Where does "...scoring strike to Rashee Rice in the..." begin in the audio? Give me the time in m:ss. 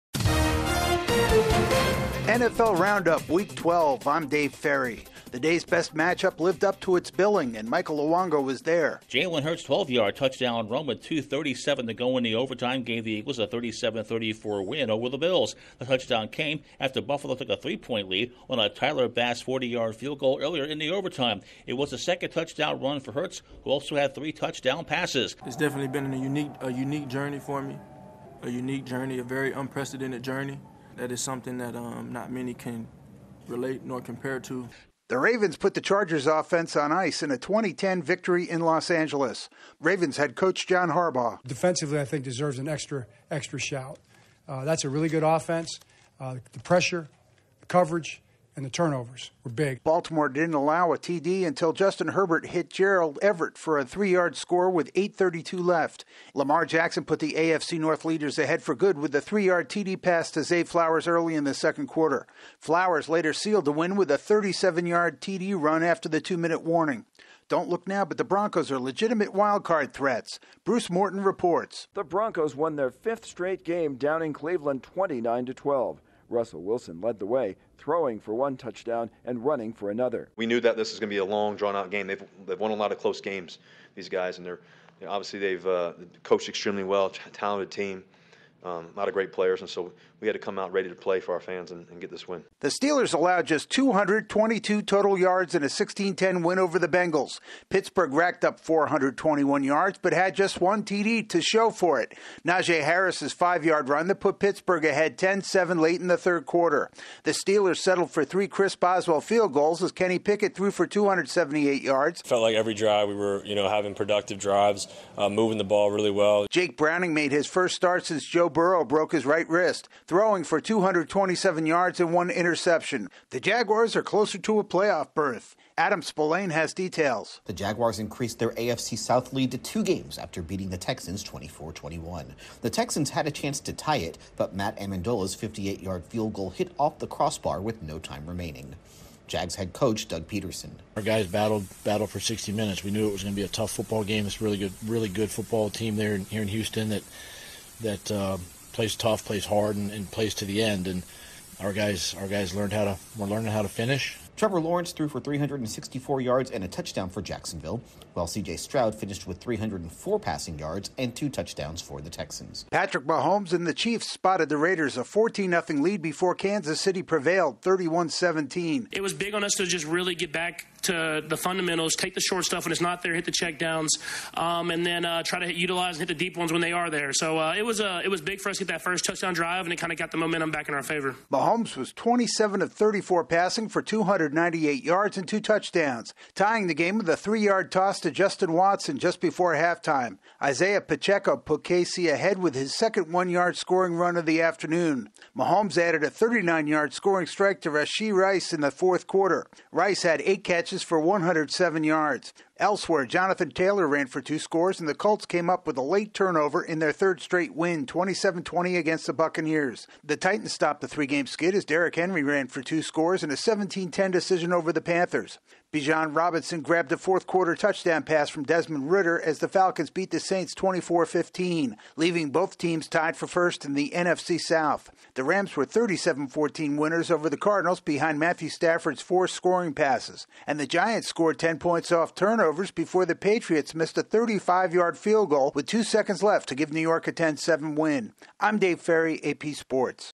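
3:16.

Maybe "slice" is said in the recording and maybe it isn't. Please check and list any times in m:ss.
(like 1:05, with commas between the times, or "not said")
not said.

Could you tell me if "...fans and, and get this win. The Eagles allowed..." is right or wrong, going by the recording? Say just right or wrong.
wrong.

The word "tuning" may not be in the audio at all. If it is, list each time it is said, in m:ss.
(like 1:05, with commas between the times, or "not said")
not said.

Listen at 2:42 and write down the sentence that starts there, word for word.
Patrick Mahomes and the Chiefs spotted the Raiders a 14 0 lead before Kansas City prevailed 31 17.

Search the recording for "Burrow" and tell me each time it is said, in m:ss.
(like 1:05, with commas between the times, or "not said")
1:58.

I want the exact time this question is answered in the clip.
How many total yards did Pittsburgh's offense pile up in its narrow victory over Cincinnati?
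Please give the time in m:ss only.
1:38.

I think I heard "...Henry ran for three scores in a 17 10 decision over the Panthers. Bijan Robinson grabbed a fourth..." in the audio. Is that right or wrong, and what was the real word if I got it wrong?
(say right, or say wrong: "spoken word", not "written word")
wrong: "two", not "three".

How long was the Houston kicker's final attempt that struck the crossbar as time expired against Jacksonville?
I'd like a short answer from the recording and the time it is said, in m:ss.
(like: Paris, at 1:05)
58 yards, at 2:15.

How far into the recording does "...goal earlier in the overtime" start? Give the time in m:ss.
0:20.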